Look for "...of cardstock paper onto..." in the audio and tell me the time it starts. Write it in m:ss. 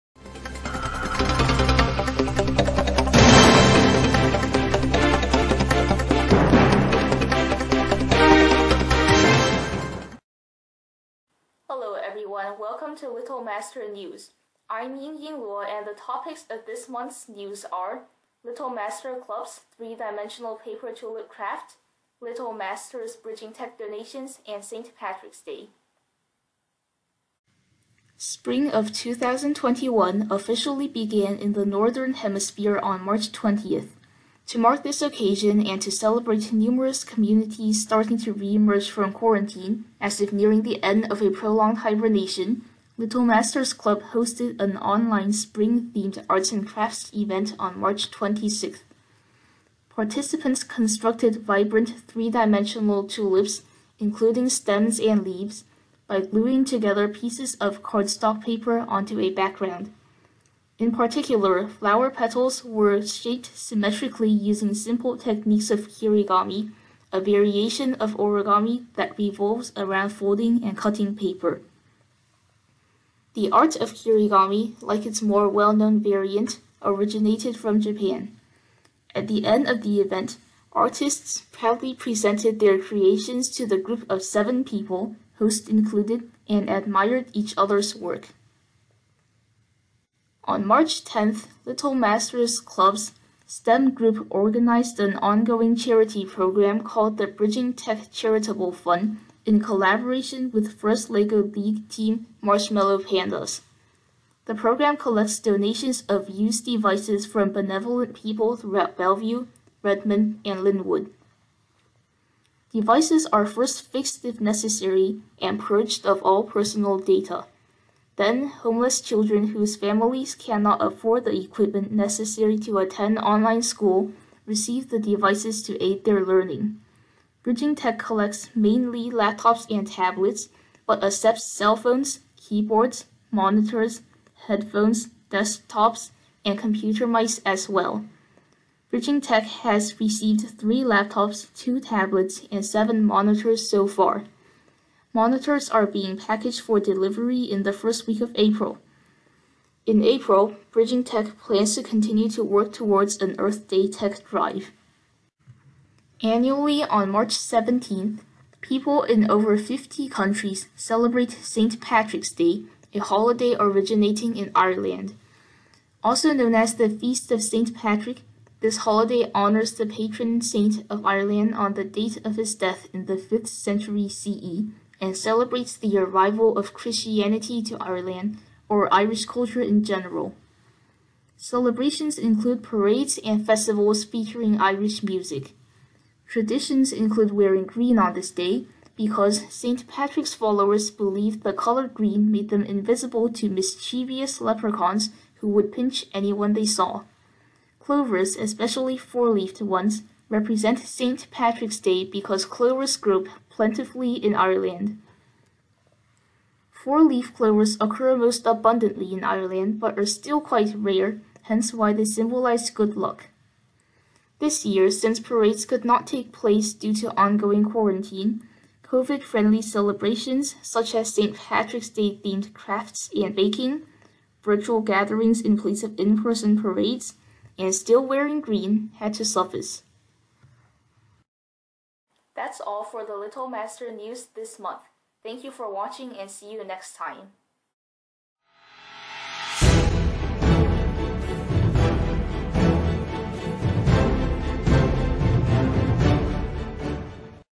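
0:57.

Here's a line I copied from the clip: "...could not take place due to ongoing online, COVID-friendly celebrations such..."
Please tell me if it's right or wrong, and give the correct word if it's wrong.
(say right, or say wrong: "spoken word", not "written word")
wrong: "quarantine", not "online".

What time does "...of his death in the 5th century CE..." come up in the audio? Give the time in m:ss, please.
2:52.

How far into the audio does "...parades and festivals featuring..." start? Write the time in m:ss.
3:02.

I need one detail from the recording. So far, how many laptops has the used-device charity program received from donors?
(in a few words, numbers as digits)
3.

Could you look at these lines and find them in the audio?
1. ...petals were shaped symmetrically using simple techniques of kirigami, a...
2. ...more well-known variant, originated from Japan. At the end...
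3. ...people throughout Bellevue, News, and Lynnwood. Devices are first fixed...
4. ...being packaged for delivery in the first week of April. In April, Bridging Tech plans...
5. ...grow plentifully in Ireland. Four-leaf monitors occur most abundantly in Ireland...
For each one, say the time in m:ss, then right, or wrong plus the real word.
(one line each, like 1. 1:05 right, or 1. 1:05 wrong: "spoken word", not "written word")
1. 1:02 right
2. 1:15 right
3. 1:48 wrong: "Redmond", not "News"
4. 2:25 right
5. 3:22 wrong: "clovers", not "monitors".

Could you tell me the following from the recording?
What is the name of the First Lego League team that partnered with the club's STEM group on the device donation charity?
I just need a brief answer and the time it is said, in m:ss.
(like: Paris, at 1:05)
Marshmallow Pandas, at 1:42.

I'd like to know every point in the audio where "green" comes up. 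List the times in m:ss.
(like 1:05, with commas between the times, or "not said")
3:07, 3:11, 3:48.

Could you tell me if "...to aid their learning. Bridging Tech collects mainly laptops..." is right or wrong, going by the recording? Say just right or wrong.
right.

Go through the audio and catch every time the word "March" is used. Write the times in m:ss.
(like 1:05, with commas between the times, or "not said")
0:33, 0:47, 1:30, 2:37.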